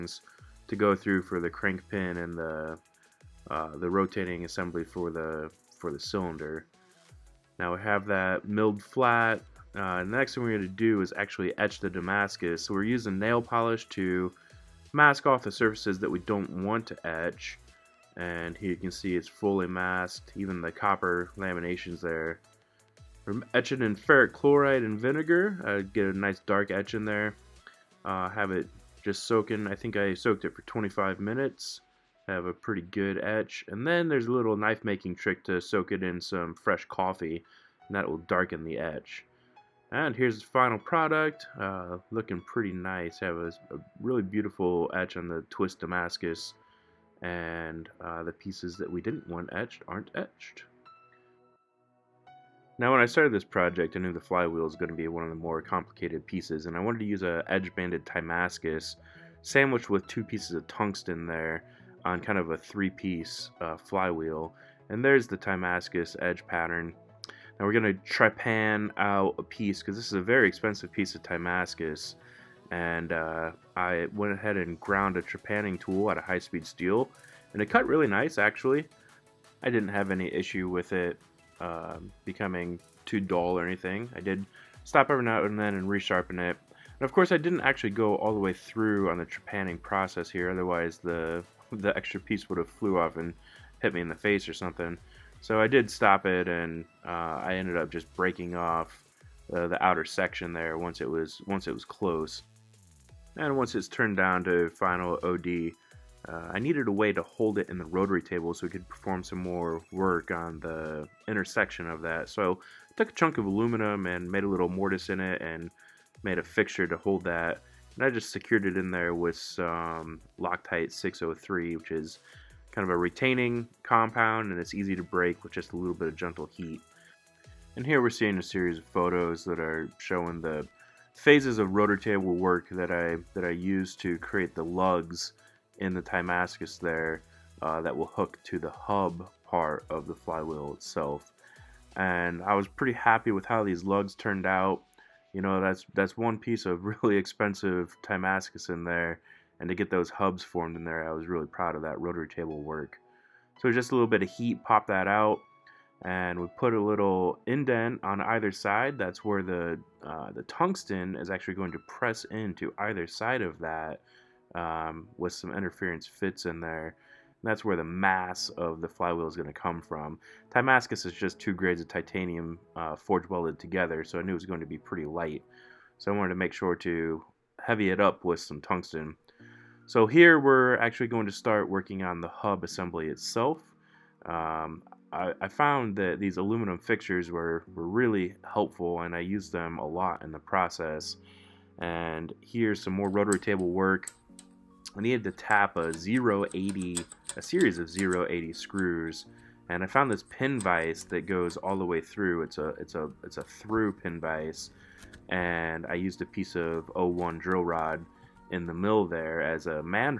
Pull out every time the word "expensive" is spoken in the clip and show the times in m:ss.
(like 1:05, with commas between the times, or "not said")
1:10, 2:27.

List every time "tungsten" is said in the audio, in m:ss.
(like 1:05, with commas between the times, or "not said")
1:00, 2:40, 2:58.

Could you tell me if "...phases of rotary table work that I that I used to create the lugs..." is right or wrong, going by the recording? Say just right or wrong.
right.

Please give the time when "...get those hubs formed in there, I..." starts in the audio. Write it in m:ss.
2:29.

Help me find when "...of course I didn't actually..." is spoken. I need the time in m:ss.
1:27.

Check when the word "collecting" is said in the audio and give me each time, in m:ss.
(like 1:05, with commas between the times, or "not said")
not said.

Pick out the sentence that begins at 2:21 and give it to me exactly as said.
And I was pretty happy with how these lugs turned out.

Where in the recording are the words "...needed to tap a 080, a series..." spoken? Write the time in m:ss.
3:15.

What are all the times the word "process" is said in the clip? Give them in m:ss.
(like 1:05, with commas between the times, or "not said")
1:29, 3:10.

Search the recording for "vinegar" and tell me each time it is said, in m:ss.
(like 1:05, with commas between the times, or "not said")
0:24.